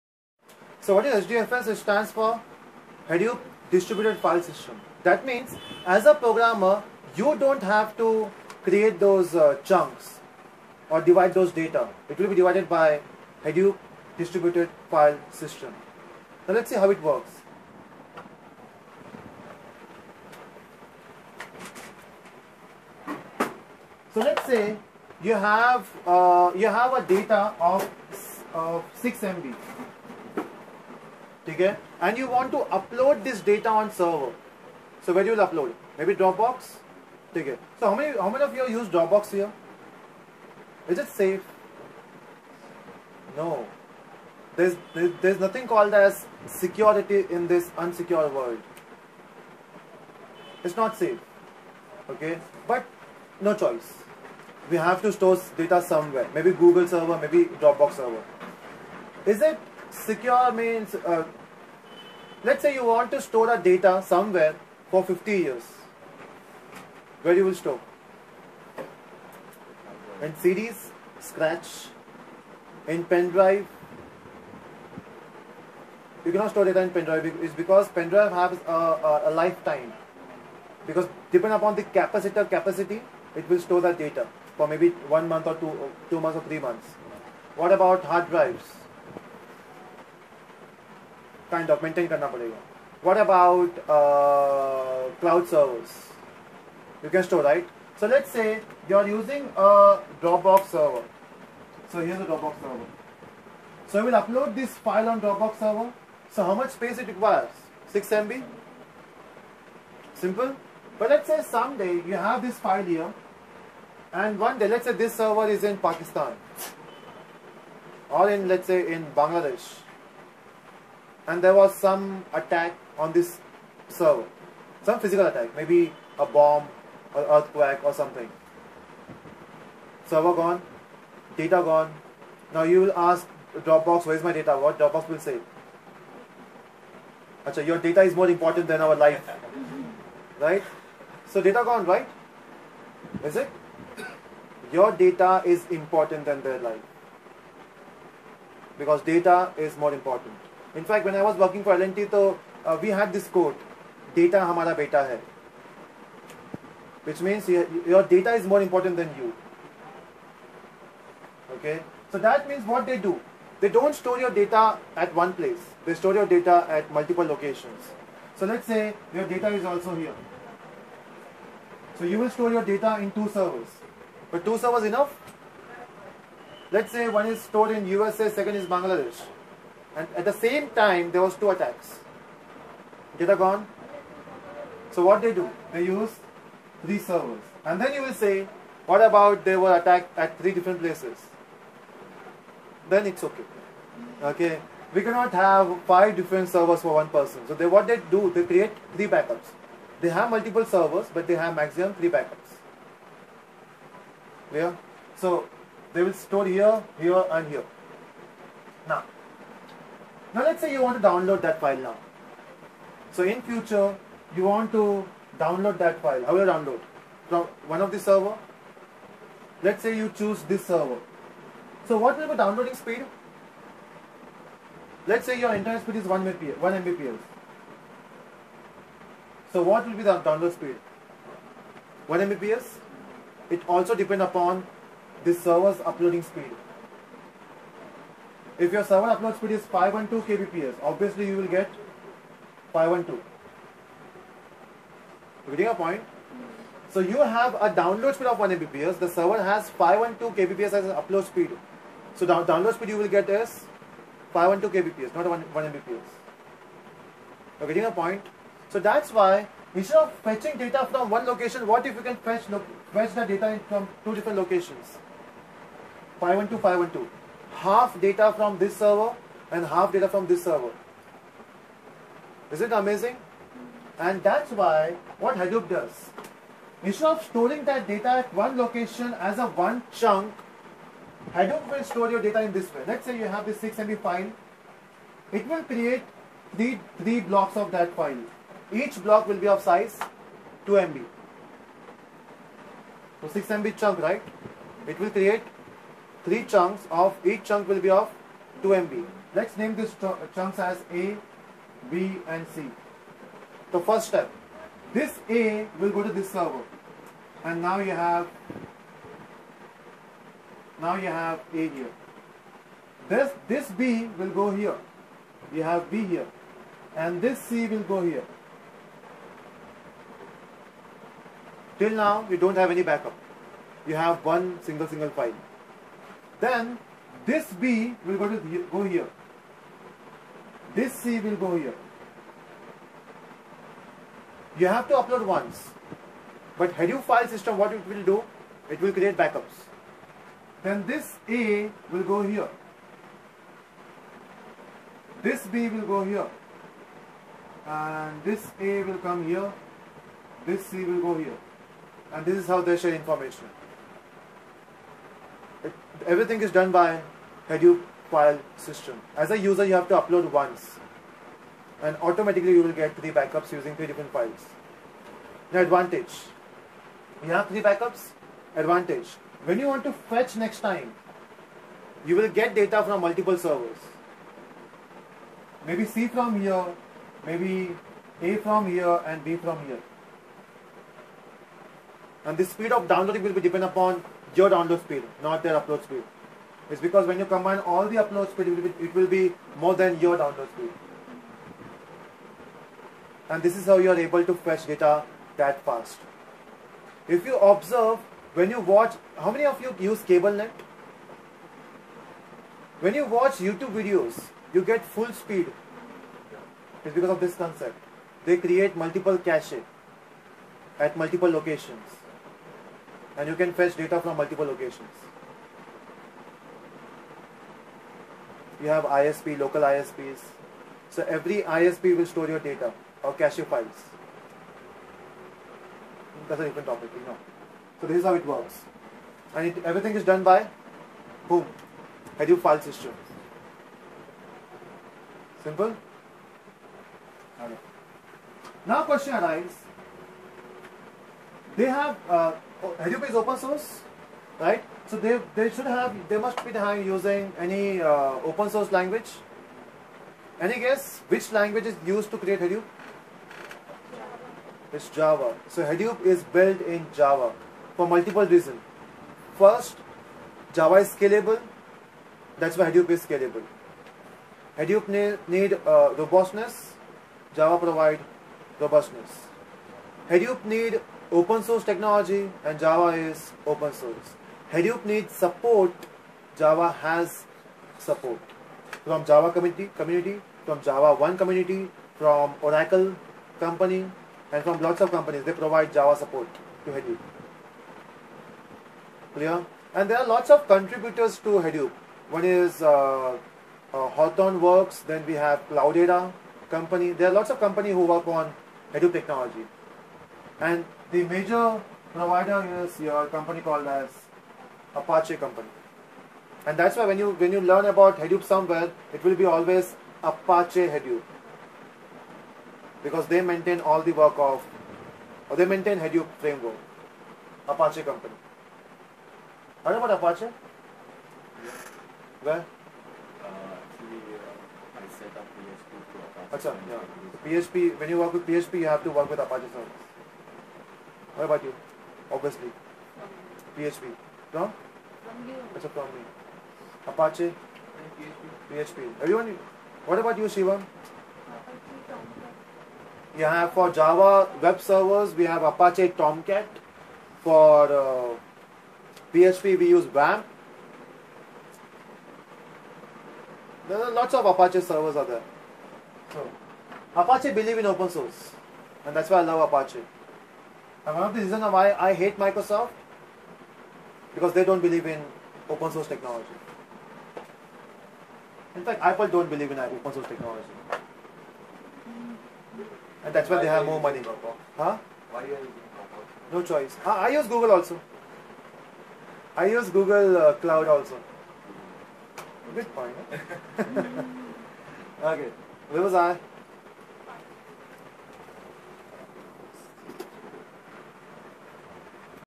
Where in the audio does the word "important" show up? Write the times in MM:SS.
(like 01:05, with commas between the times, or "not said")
02:18, 02:25, 02:29, 02:38.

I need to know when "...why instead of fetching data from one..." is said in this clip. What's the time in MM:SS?
04:19.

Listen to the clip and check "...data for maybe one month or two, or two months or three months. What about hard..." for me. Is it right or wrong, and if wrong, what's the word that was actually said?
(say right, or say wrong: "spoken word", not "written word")
right.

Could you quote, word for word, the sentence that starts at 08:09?
And there are lots of contributors to Hadoop.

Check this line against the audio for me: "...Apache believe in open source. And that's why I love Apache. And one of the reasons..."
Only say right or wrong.
right.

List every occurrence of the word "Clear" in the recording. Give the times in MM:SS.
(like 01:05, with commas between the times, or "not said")
03:24, 08:09.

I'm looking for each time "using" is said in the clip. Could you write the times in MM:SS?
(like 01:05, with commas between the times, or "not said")
01:39, 06:03, 07:26, 09:35.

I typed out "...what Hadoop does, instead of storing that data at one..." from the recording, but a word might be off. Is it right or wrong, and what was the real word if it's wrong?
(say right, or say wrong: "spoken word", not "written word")
right.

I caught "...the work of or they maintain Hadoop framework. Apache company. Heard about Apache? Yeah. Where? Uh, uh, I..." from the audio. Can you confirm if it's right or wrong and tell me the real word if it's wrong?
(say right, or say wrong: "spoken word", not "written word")
right.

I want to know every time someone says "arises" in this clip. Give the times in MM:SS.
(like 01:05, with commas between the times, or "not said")
07:19.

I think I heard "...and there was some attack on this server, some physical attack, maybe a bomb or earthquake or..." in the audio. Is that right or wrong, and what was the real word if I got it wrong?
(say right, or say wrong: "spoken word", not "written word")
right.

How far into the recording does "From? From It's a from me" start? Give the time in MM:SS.
08:54.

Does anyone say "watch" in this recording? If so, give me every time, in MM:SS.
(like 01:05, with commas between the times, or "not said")
06:38, 06:43.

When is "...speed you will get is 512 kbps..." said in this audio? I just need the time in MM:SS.
04:12.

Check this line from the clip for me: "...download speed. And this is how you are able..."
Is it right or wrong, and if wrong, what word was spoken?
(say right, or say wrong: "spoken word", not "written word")
right.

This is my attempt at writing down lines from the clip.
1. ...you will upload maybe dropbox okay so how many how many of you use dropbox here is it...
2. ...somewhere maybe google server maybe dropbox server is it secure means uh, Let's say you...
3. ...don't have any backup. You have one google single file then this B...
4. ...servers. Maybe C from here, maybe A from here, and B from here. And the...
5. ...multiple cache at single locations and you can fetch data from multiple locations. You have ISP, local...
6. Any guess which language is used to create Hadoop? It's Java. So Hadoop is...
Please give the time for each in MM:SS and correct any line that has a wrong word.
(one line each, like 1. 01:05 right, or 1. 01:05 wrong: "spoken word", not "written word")
1. 00:35 right
2. 00:55 right
3. 05:22 wrong: "single", not "google"
4. 06:13 right
5. 06:48 wrong: "multiple", not "single"
6. 07:30 right.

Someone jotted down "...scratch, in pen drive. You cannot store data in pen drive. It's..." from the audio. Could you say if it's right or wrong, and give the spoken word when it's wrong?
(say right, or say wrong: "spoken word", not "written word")
right.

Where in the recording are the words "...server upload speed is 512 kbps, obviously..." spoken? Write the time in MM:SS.
03:58.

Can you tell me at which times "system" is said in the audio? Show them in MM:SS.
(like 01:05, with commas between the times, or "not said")
00:04, 00:15, 05:37, 05:58, 07:12.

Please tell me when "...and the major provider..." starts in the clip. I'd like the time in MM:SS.
08:20.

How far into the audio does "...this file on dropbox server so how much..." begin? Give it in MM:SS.
01:44.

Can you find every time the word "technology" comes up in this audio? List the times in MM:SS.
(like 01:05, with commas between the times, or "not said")
07:51, 08:18, 09:25, 09:30.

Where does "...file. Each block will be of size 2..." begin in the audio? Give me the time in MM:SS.
04:47.